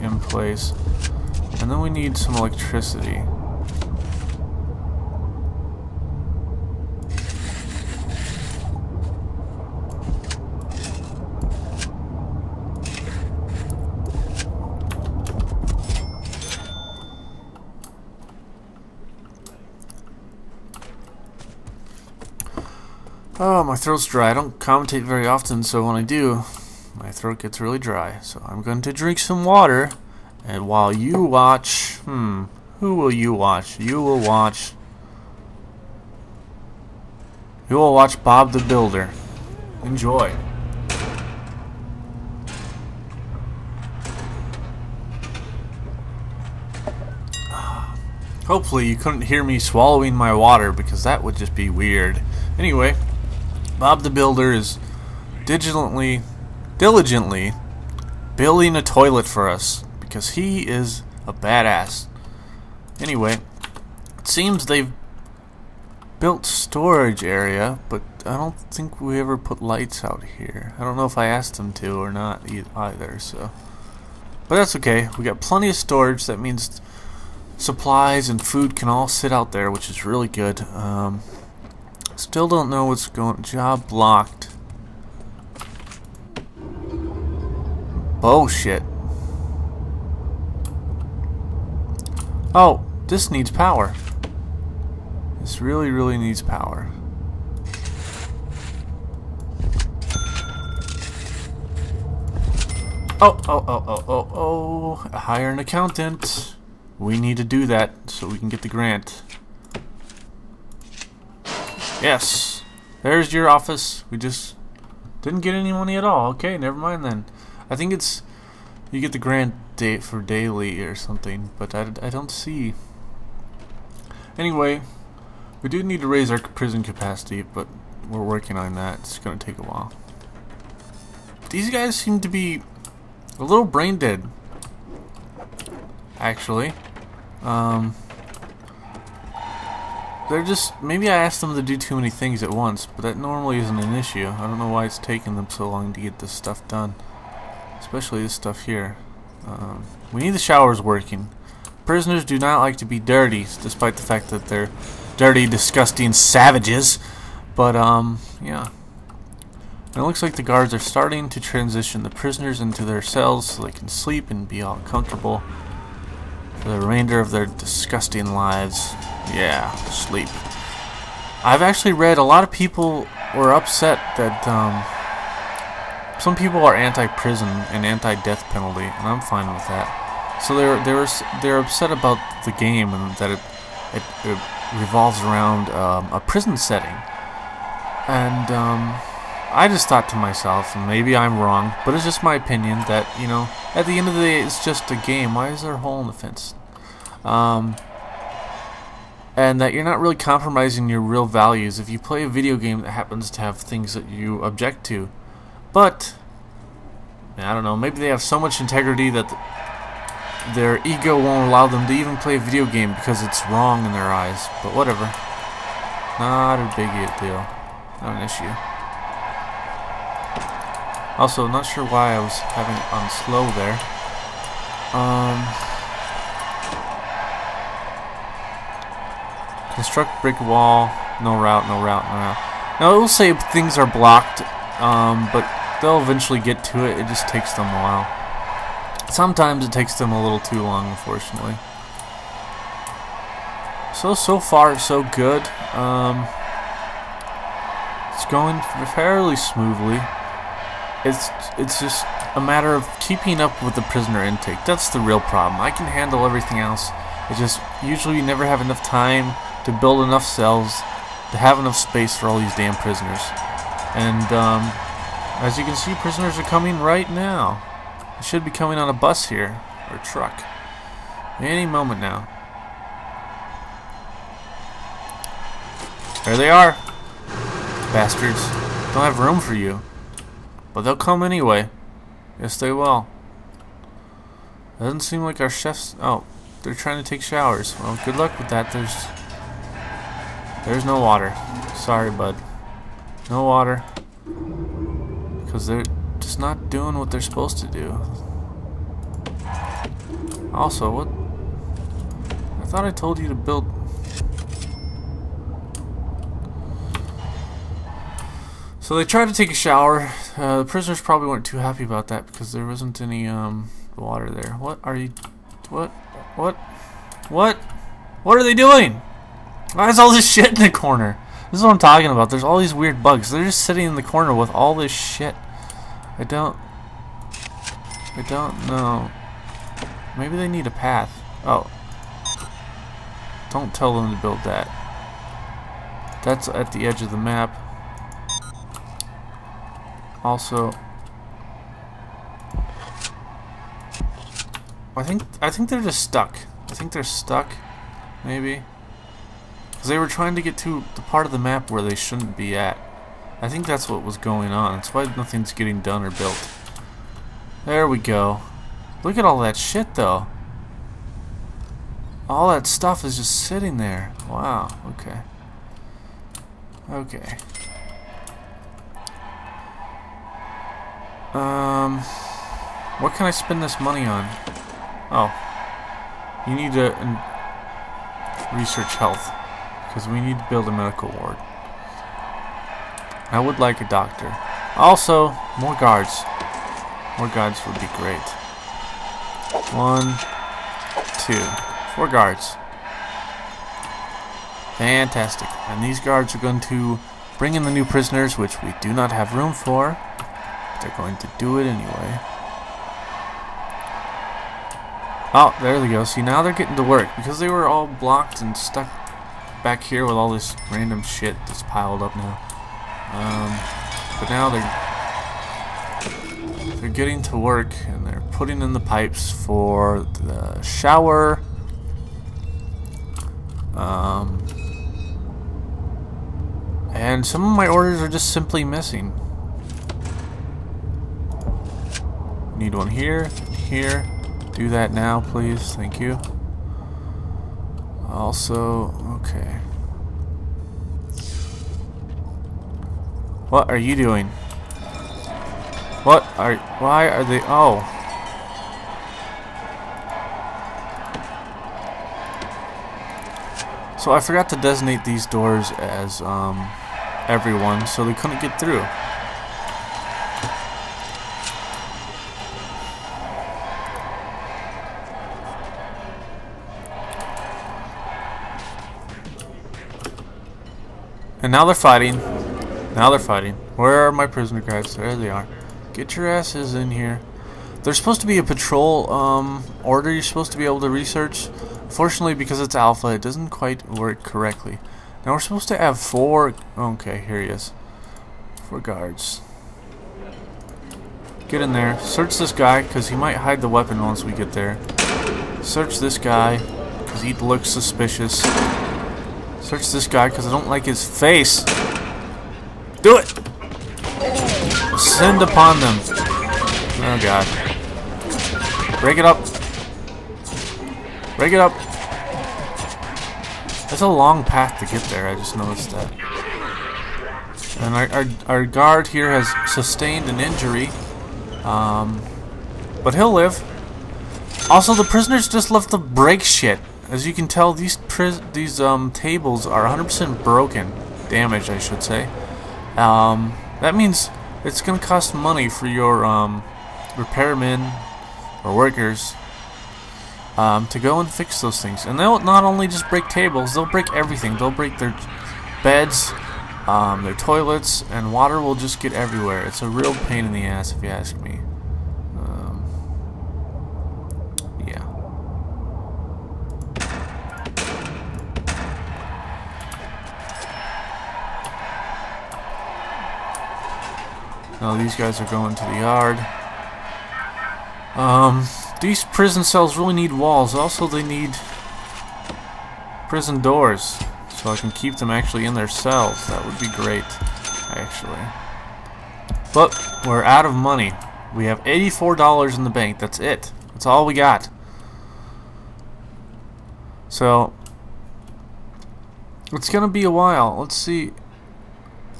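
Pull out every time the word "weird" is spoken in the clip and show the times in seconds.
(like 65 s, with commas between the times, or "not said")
51 s, 322 s.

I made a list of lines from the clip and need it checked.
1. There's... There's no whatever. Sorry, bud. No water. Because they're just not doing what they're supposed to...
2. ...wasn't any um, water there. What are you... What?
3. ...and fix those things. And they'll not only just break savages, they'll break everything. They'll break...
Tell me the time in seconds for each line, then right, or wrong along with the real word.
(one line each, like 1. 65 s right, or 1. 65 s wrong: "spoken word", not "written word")
1. 288 s wrong: "water", not "whatever"
2. 312 s right
3. 541 s wrong: "tables", not "savages".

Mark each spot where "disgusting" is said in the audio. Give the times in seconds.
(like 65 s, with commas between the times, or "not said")
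155 s, 167 s.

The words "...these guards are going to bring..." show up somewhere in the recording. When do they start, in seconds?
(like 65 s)
395 s.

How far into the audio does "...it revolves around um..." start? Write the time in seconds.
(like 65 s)
184 s.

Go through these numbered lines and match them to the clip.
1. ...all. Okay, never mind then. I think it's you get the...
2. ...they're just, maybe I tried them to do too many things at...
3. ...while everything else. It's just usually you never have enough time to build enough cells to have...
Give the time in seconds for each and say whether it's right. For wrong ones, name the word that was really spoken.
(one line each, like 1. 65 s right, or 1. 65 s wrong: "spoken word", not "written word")
1. 116 s right
2. 140 s wrong: "asked", not "tried"
3. 255 s wrong: "handle", not "while".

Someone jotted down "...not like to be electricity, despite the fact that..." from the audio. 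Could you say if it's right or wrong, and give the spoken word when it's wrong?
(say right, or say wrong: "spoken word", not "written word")
wrong: "dirty", not "electricity".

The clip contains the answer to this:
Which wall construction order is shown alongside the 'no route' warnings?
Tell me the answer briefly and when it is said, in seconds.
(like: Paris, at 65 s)
Brick wall, at 230 s.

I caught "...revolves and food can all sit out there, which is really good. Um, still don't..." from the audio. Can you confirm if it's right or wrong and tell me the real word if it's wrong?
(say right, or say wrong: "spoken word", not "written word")
wrong: "supplies", not "revolves".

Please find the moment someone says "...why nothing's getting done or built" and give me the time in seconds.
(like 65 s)
354 s.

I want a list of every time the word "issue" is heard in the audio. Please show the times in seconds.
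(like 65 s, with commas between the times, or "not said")
143 s, 218 s.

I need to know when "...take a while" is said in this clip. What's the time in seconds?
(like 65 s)
129 s.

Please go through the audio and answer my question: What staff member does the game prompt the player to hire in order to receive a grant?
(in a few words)
An accountant.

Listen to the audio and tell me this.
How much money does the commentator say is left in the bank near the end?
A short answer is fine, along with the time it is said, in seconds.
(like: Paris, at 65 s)
$84, at 581 s.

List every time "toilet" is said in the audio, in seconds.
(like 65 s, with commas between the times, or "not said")
58 s, 547 s.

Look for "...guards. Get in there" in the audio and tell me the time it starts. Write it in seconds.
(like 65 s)
488 s.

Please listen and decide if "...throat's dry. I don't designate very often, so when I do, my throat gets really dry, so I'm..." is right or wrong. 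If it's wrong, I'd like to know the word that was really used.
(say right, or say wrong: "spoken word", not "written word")
wrong: "commentate", not "designate".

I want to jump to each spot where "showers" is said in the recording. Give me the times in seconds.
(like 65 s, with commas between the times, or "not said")
150 s, 287 s, 309 s, 420 s.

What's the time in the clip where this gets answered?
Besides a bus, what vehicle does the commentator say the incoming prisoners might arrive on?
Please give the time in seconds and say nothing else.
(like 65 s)
269 s.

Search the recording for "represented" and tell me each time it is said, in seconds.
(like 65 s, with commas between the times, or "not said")
not said.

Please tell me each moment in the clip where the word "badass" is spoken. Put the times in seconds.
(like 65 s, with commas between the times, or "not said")
61 s.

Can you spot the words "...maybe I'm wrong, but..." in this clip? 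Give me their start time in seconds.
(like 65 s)
190 s.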